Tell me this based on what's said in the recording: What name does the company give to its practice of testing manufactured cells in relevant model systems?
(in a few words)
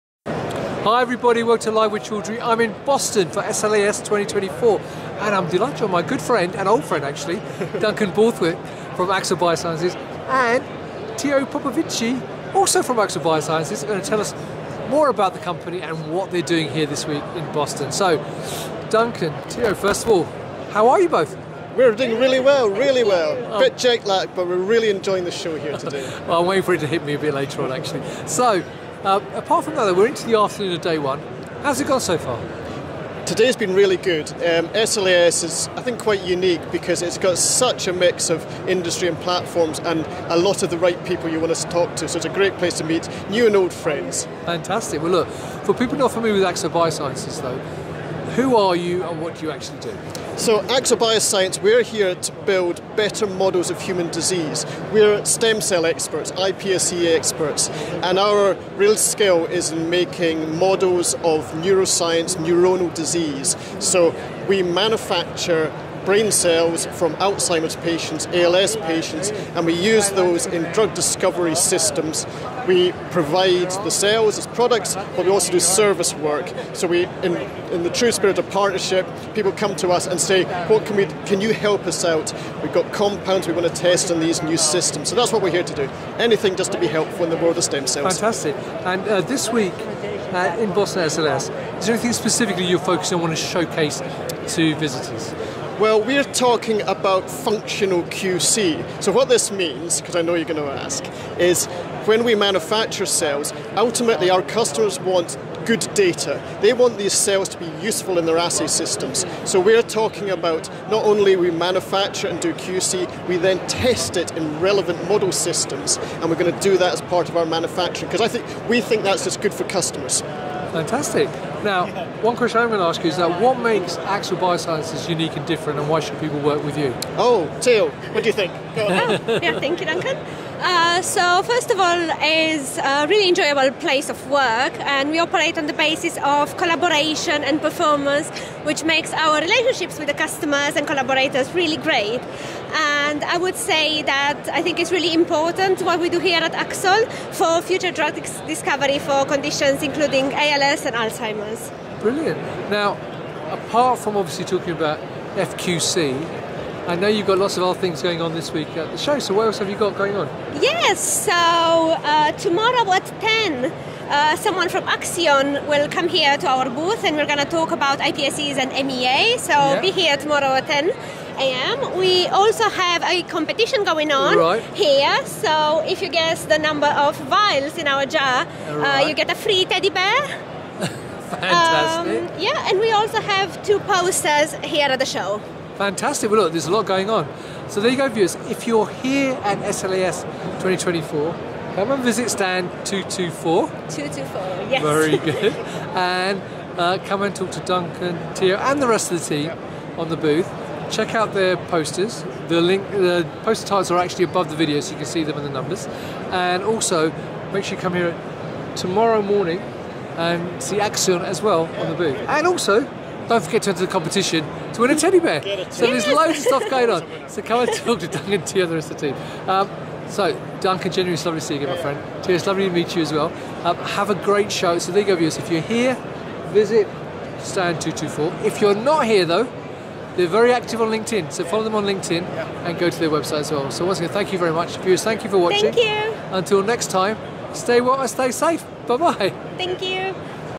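Functional QC.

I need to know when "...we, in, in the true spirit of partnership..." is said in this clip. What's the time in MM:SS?
01:16.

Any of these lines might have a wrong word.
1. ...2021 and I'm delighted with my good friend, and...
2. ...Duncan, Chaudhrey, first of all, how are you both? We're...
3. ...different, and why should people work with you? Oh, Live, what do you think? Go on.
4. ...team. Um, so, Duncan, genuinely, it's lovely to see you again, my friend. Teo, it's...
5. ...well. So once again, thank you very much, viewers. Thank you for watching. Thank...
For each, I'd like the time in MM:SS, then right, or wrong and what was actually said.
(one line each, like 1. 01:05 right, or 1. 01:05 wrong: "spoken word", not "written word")
1. 00:03 wrong: "2024", not "2021"
2. 00:18 wrong: "Teo", not "Chaudhrey"
3. 02:05 wrong: "Teal", not "Live"
4. 03:39 right
5. 03:53 right.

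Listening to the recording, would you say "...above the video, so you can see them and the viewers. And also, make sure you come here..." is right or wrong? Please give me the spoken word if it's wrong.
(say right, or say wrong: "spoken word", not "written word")
wrong: "numbers", not "viewers".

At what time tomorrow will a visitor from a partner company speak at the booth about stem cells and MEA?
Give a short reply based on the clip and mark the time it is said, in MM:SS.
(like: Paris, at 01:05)
10 a.m., at 02:50.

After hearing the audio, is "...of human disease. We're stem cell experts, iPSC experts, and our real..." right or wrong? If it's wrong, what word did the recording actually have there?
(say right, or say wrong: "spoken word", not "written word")
right.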